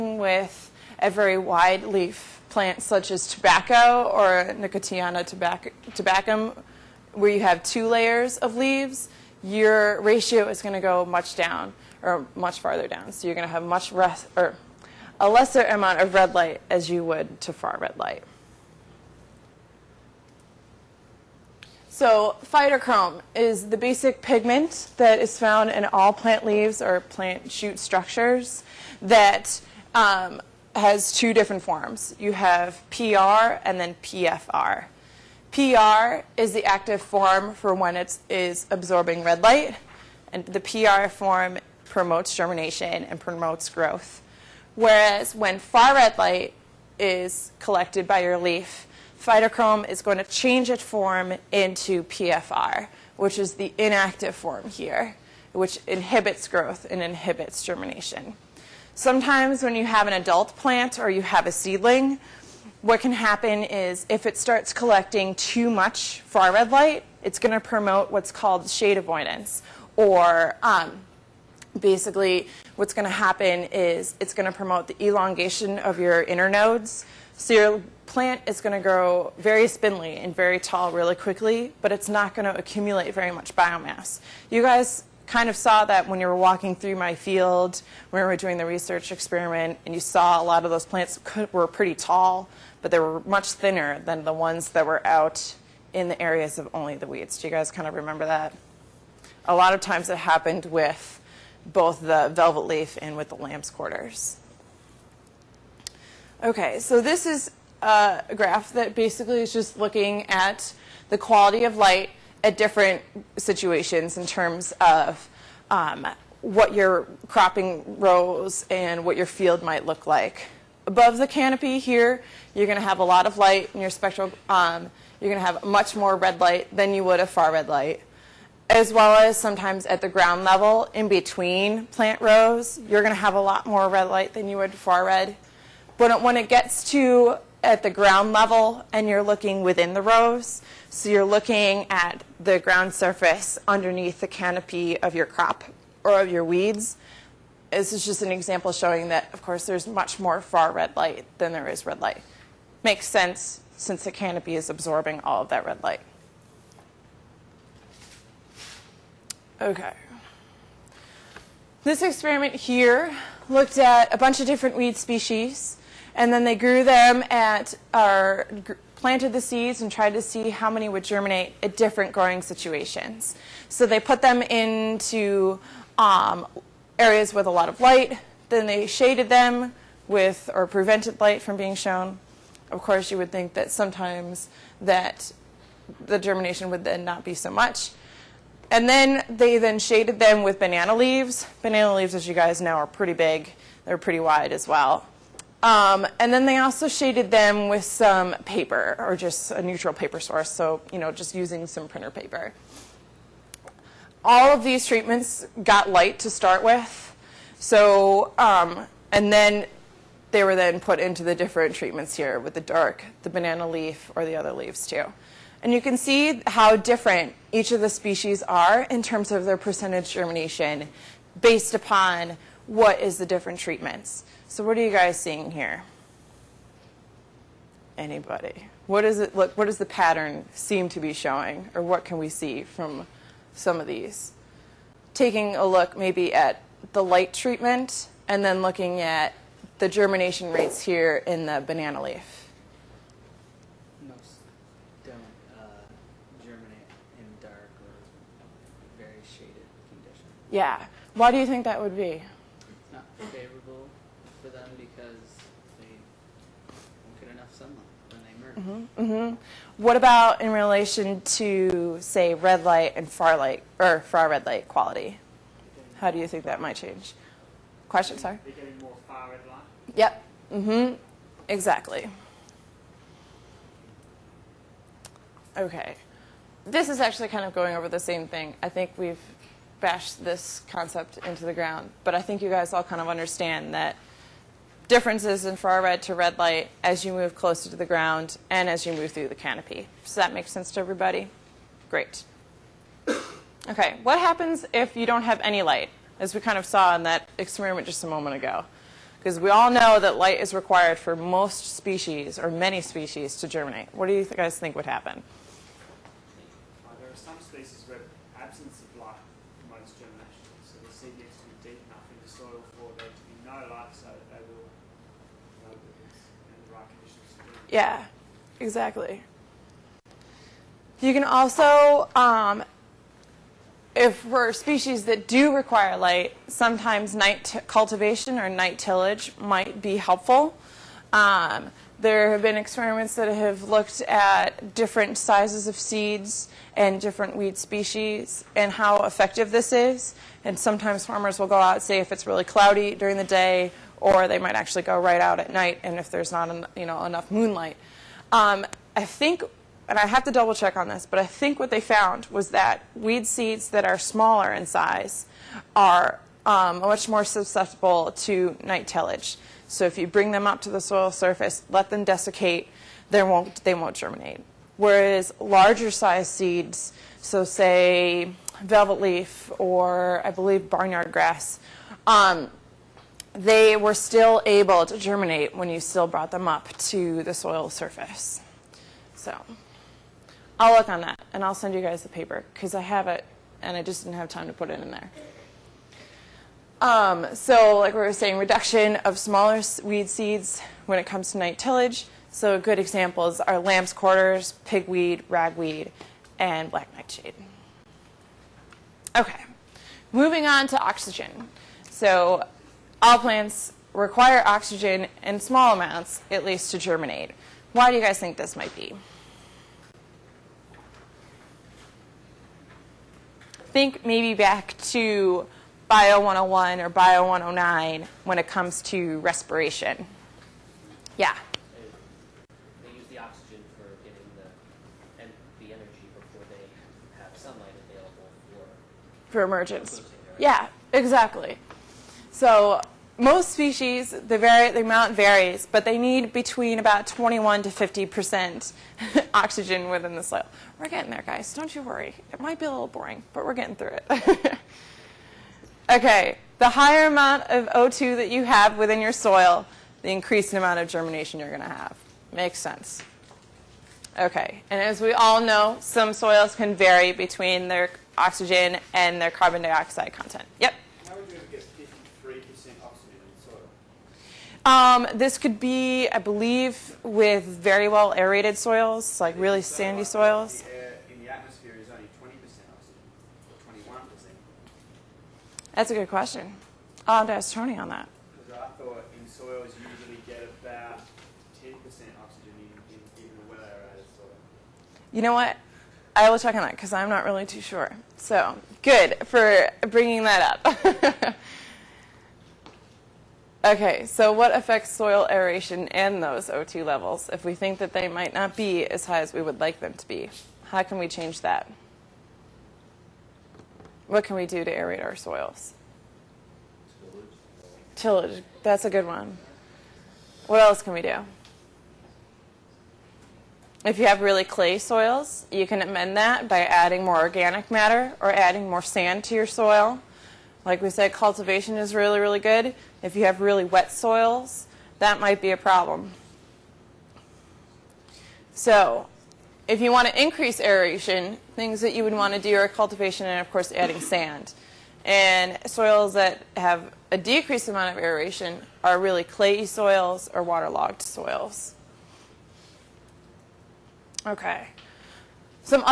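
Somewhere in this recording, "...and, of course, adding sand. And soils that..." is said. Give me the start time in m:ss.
8:53.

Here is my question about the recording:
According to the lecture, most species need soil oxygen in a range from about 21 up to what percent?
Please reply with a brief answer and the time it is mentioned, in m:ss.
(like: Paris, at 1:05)
50%, at 7:17.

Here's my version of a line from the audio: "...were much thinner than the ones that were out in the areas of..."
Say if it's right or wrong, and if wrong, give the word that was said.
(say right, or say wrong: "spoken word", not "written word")
right.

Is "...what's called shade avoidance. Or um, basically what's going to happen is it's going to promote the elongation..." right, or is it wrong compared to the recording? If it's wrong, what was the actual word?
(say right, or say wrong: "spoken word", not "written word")
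right.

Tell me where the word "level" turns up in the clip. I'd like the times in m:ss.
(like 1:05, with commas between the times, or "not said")
2:10, 2:18, 8:16.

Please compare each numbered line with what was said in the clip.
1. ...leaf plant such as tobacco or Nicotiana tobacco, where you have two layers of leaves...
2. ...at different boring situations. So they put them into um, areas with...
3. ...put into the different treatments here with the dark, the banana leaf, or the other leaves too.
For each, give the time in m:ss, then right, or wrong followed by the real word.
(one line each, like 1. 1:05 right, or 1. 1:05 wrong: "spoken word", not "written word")
1. 0:01 right
2. 2:51 wrong: "growing", not "boring"
3. 3:30 right.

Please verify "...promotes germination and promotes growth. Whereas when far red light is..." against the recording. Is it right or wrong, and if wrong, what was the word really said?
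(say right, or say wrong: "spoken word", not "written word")
right.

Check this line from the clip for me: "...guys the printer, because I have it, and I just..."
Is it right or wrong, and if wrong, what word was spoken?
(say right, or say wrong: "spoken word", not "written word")
wrong: "paper", not "printer".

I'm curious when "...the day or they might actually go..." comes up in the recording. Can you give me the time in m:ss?
5:43.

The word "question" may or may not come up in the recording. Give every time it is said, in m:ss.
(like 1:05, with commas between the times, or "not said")
4:27, 7:56.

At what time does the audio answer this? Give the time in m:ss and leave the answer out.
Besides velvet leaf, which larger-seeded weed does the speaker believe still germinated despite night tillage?
6:10.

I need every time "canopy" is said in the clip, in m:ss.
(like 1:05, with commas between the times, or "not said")
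2:01, 2:24, 2:34, 4:49.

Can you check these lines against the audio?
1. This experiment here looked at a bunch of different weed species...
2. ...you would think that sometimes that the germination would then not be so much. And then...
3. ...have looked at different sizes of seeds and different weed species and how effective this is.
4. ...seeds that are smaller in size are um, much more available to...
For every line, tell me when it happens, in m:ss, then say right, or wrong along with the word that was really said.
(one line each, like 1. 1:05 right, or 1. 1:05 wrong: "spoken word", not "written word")
1. 2:41 right
2. 3:03 right
3. 5:33 right
4. 5:53 wrong: "susceptible", not "available".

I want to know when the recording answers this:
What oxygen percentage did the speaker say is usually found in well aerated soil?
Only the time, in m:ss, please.
8:01.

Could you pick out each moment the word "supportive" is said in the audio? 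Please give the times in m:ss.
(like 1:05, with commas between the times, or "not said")
not said.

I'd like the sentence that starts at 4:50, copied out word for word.
Does that make sense to everybody?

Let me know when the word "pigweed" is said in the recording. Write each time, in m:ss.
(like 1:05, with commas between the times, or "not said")
6:34.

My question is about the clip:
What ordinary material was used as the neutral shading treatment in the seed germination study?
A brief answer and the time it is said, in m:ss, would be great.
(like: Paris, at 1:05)
printer paper, at 3:21.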